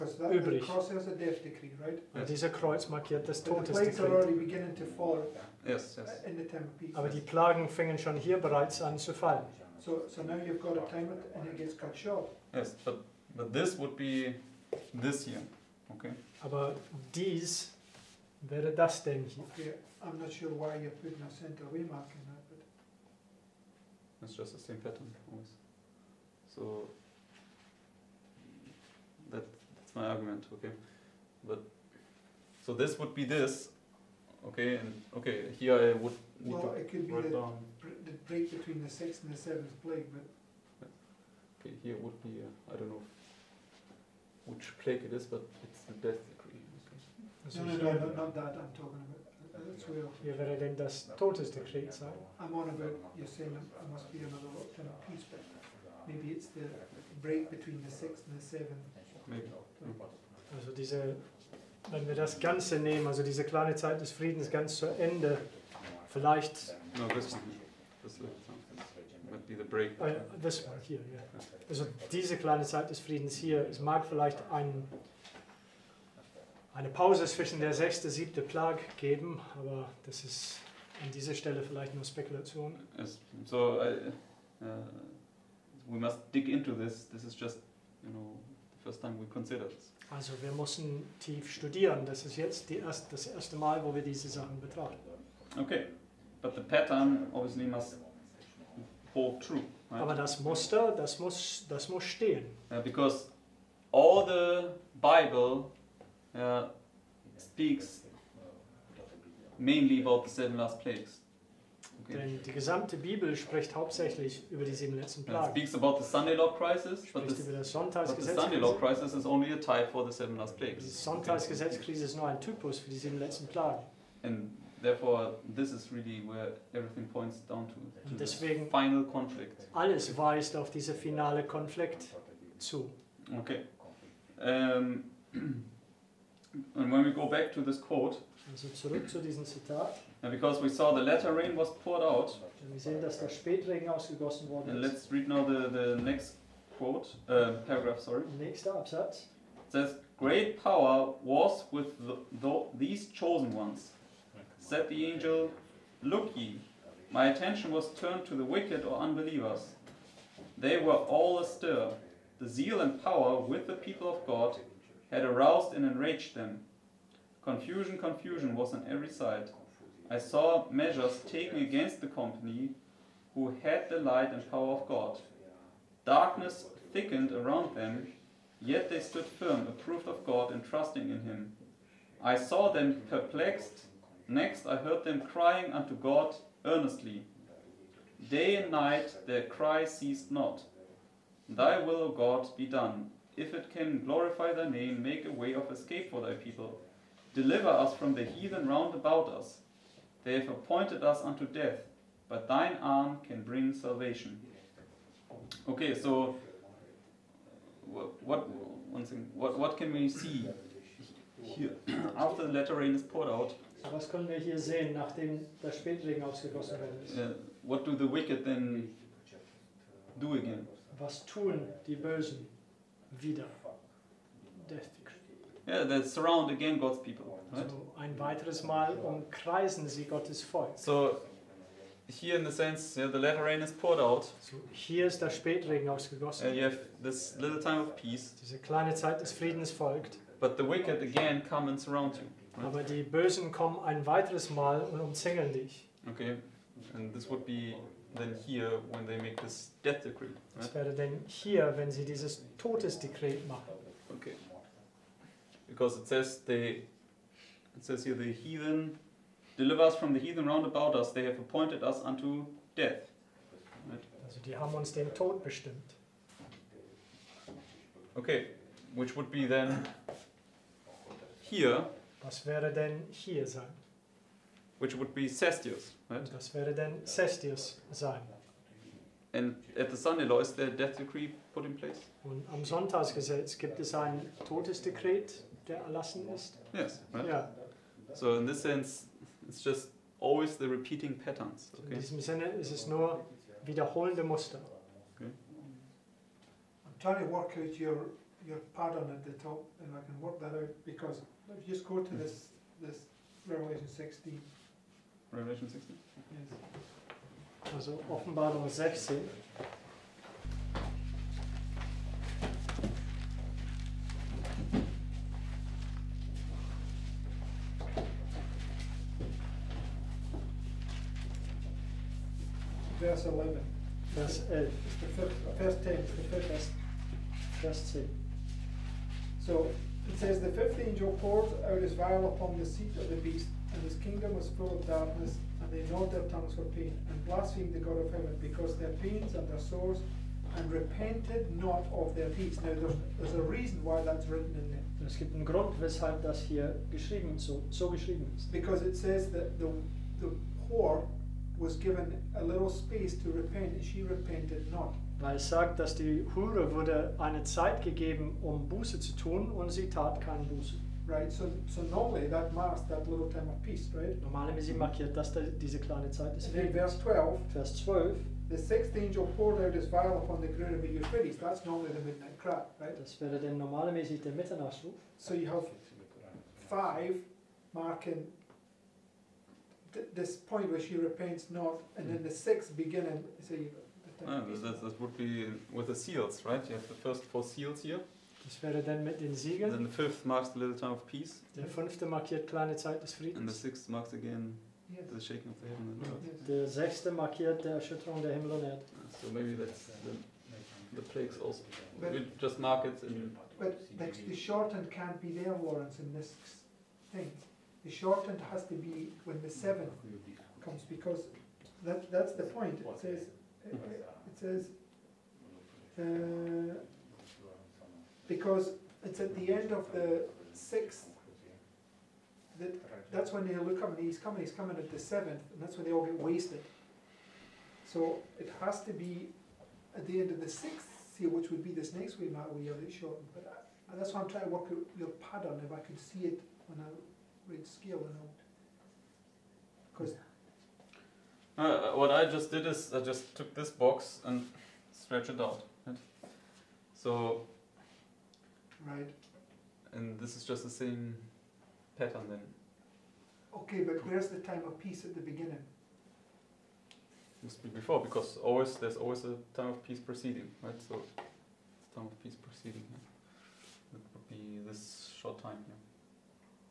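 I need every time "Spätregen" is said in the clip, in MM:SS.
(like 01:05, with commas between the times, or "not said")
02:23, 03:35, 03:55.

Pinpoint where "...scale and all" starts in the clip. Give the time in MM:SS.
07:17.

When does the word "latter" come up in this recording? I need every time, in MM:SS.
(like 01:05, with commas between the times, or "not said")
02:21, 03:32, 03:53.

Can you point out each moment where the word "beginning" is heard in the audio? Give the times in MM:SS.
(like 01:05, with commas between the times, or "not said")
06:22, 07:35.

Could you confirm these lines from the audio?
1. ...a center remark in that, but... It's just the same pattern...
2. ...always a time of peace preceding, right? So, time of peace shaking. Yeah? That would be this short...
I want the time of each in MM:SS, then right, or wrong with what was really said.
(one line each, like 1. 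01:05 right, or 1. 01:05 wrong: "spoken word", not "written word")
1. 00:21 right
2. 07:38 wrong: "preceding", not "shaking".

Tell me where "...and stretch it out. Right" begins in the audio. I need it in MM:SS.
07:24.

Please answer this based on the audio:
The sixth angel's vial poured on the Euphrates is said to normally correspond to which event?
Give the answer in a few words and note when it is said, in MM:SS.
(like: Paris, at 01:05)
The midnight cry, at 06:11.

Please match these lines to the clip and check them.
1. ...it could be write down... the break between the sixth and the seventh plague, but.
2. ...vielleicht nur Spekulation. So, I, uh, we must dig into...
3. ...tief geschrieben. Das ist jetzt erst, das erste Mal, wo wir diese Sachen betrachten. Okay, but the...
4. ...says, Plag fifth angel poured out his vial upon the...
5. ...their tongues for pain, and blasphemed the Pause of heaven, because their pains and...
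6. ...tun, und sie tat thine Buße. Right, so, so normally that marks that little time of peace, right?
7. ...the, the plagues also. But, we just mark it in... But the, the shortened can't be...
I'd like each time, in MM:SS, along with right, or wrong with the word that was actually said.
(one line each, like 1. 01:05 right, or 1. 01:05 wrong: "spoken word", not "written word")
1. 00:36 right
2. 01:21 right
3. 01:31 wrong: "studieren", not "geschrieben"
4. 05:30 wrong: "The", not "Plag"
5. 05:36 wrong: "God", not "Pause"
6. 05:59 wrong: "keine", not "thine"
7. 06:40 right.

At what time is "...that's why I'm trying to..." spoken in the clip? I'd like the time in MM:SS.
07:13.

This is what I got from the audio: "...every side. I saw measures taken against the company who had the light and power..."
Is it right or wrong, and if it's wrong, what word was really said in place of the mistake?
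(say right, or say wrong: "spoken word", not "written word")
right.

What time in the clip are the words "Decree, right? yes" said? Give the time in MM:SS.
00:00.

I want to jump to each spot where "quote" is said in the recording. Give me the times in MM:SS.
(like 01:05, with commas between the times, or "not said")
02:17, 02:26.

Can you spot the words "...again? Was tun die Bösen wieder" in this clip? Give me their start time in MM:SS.
03:40.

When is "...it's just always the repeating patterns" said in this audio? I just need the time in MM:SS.
04:49.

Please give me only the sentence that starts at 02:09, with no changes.
Alles weist auf diese finale Konflikt zu.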